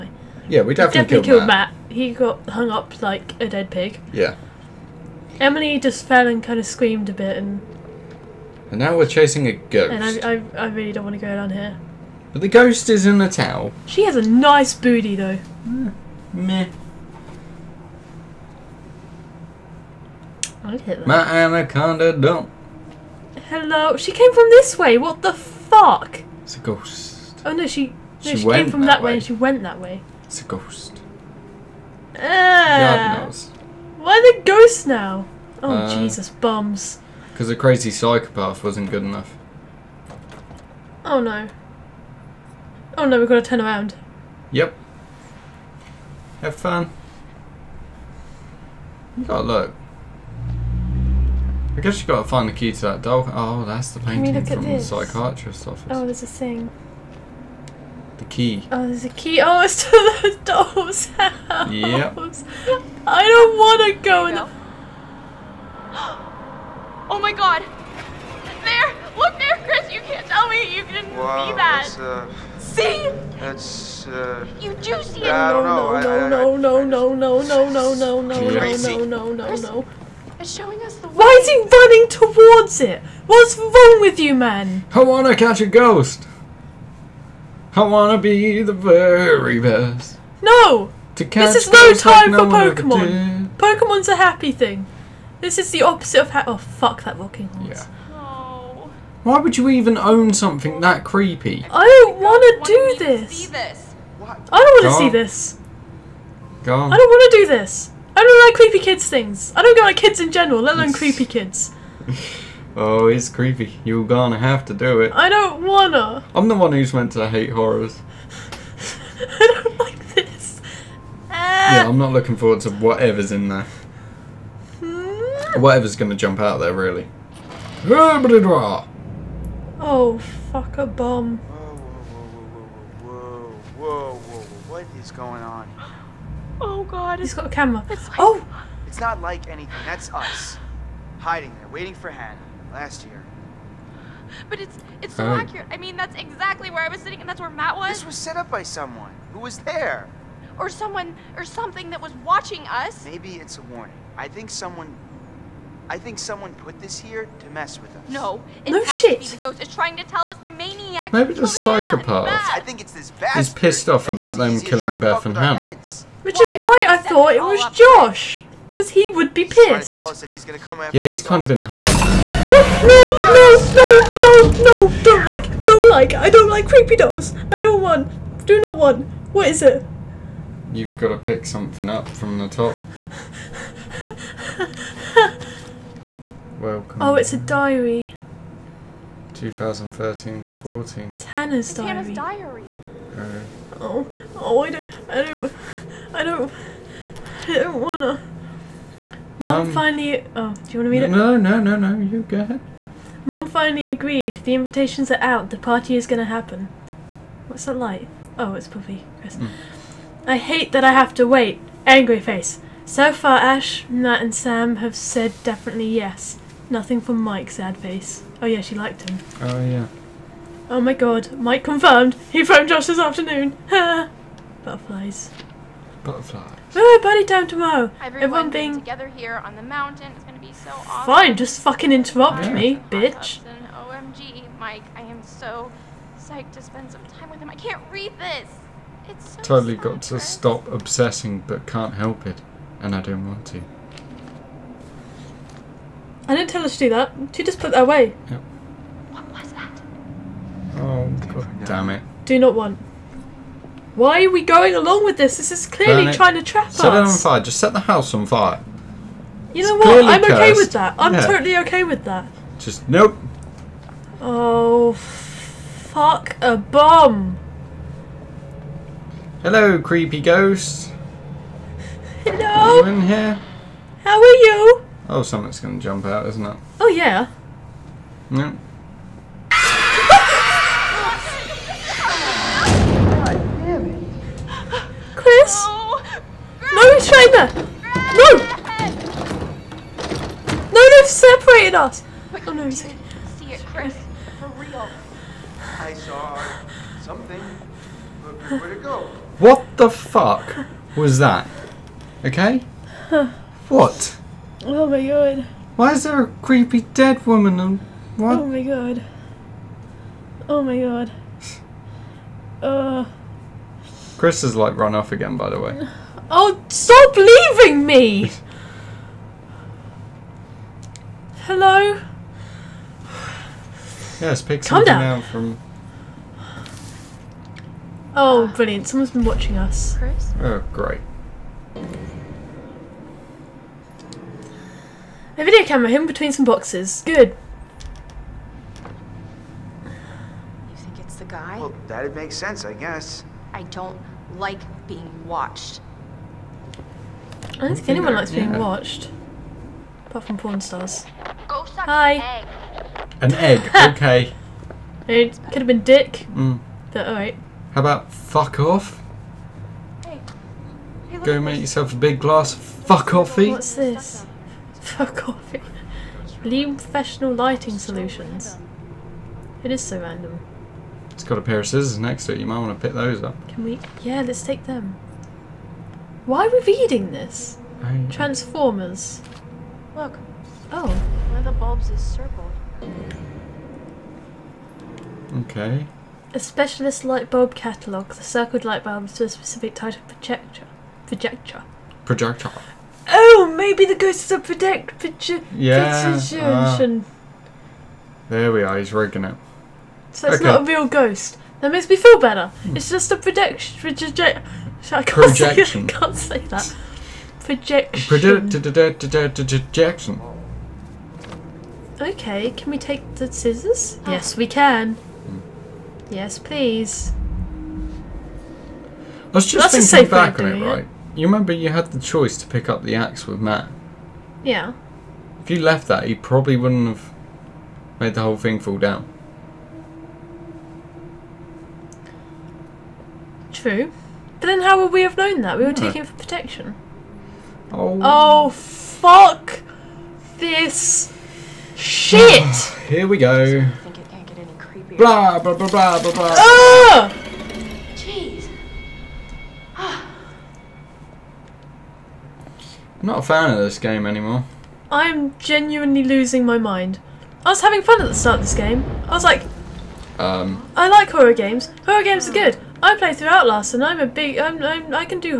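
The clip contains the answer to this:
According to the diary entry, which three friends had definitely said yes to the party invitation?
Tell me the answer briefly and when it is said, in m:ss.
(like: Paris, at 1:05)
Ash, Matt, and Sam, at 3:33.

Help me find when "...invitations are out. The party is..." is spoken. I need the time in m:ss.
3:24.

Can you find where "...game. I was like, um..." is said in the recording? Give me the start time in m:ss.
7:38.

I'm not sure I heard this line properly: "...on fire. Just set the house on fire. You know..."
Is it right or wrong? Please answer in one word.
right.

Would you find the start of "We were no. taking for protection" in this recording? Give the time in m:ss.
7:15.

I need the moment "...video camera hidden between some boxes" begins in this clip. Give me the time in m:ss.
5:35.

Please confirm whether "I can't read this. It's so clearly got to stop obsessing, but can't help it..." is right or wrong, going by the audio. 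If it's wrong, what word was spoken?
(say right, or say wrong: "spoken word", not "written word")
wrong: "totally", not "clearly".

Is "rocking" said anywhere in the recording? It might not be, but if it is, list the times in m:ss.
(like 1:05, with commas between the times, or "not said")
1:37.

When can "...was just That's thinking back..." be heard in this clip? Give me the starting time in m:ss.
6:59.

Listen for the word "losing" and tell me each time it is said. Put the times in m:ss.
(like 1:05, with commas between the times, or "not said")
7:36.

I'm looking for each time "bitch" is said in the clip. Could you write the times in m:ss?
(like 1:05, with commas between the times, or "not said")
3:52.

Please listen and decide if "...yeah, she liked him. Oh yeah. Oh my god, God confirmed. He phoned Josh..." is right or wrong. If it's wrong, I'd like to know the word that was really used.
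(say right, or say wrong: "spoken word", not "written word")
wrong: "Mike", not "God".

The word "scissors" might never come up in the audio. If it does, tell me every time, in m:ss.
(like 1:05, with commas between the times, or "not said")
6:11, 6:53.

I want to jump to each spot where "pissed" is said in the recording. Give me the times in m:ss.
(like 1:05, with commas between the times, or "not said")
2:43, 2:49.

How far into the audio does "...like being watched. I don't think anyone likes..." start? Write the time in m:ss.
5:44.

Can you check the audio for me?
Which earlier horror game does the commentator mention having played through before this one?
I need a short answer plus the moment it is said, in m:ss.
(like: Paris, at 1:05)
Outlast, at 7:43.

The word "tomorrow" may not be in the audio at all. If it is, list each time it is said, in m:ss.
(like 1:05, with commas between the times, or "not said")
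3:47.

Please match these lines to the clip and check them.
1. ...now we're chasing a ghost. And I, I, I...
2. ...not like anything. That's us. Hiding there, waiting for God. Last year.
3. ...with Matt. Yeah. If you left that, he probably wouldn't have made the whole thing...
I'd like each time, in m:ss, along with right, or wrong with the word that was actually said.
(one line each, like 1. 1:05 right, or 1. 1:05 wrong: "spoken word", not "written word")
1. 0:08 right
2. 2:18 wrong: "Hannah", not "God"
3. 7:03 right.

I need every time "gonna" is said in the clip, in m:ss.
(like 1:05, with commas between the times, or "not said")
1:54, 2:05, 3:26, 3:50.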